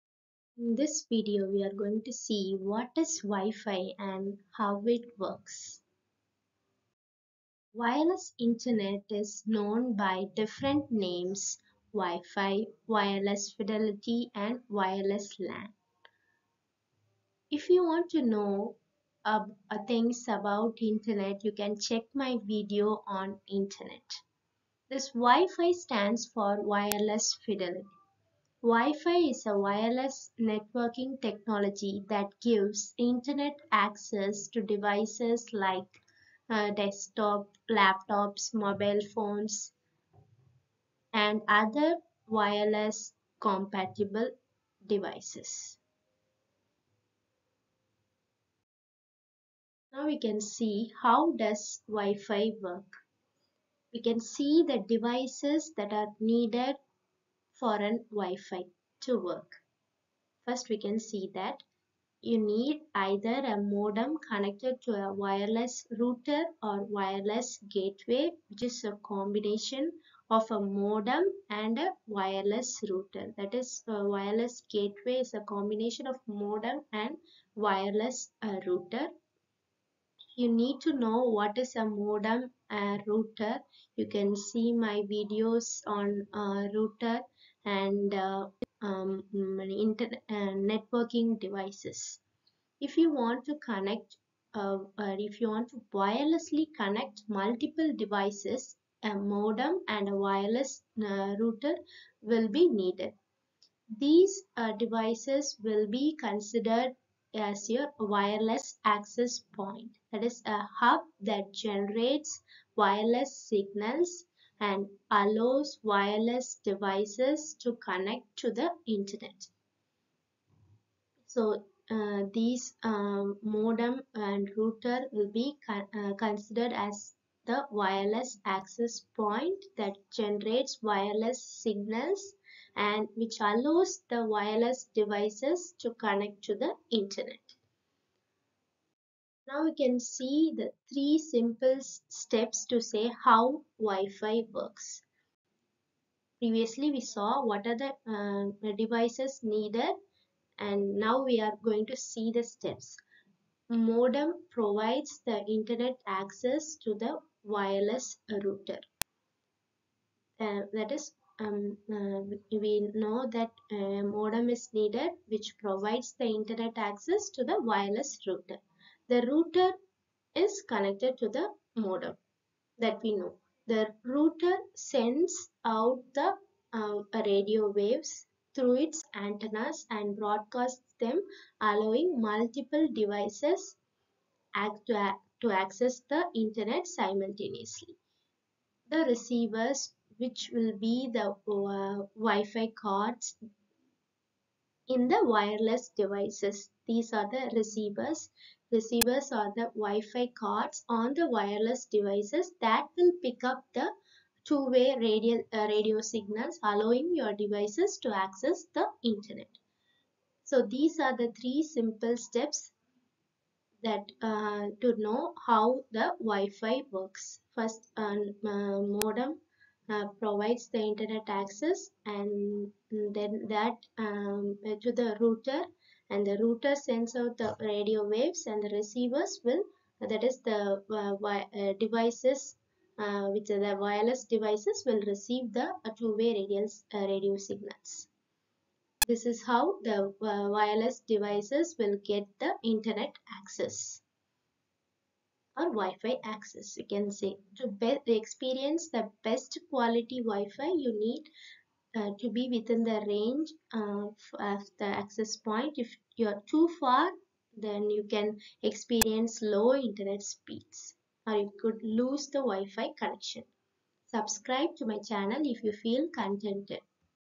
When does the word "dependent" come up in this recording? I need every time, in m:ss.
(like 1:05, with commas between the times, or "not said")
not said.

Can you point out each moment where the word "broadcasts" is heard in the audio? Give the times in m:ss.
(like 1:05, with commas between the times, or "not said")
3:00.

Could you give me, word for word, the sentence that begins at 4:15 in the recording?
If you are too far, then you can experience low internet speeds or you could lose the Wi-Fi connection.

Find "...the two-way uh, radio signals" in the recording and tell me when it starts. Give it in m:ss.
3:55.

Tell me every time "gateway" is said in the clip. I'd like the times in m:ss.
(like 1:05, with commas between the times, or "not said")
1:07, 1:14.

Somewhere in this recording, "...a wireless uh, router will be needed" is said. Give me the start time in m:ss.
1:40.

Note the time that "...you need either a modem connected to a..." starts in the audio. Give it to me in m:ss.
1:02.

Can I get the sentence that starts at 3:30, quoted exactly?
So these are the three simple steps that uh, to know how the Wi-Fi works.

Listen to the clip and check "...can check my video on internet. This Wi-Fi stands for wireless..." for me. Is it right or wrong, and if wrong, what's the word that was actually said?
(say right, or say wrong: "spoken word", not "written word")
right.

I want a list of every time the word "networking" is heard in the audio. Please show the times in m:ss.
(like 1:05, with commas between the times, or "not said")
0:30, 1:30.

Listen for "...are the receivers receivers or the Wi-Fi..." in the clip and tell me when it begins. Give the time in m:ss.
3:17.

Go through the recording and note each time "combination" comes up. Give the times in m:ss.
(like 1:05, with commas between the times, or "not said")
1:09, 1:15.